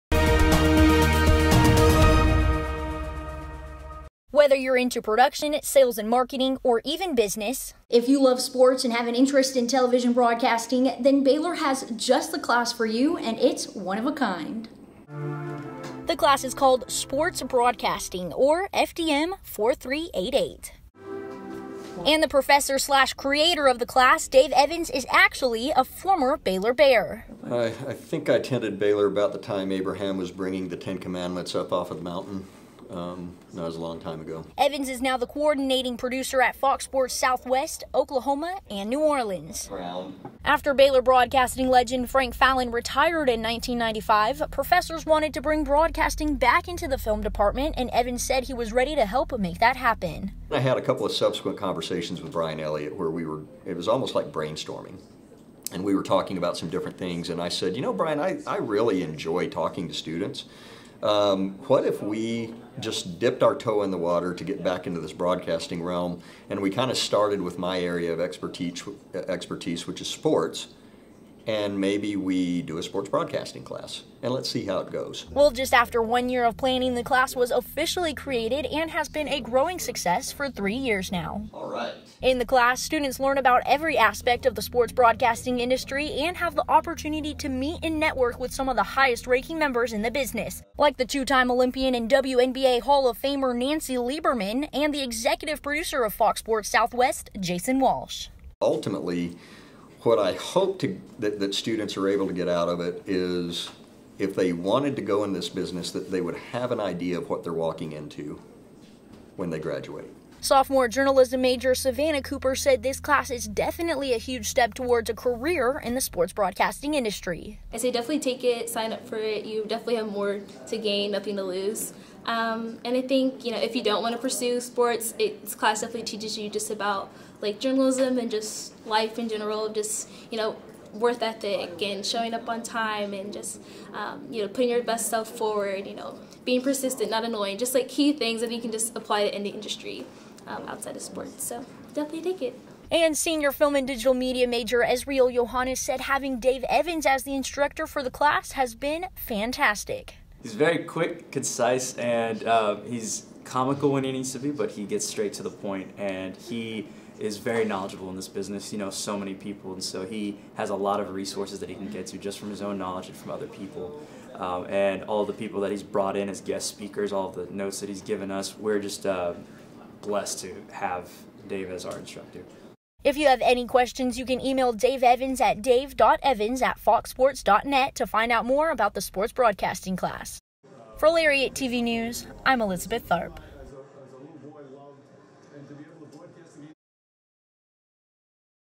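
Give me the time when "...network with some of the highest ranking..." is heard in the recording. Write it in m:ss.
1:27.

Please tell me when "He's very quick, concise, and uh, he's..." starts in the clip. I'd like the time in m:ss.
2:30.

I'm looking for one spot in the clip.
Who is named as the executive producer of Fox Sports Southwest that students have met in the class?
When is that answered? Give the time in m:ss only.
1:37.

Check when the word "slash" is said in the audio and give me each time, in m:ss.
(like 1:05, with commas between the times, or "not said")
0:22.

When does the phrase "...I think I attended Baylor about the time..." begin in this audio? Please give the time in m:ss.
0:27.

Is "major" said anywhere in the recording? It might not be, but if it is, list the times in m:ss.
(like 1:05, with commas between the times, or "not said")
1:51, 2:24.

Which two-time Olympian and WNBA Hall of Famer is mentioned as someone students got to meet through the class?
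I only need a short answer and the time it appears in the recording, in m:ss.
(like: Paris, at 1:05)
Nancy Lieberman, at 1:33.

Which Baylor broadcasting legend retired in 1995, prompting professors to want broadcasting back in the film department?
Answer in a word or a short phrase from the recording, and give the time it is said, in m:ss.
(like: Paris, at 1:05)
Frank Fallon, at 0:42.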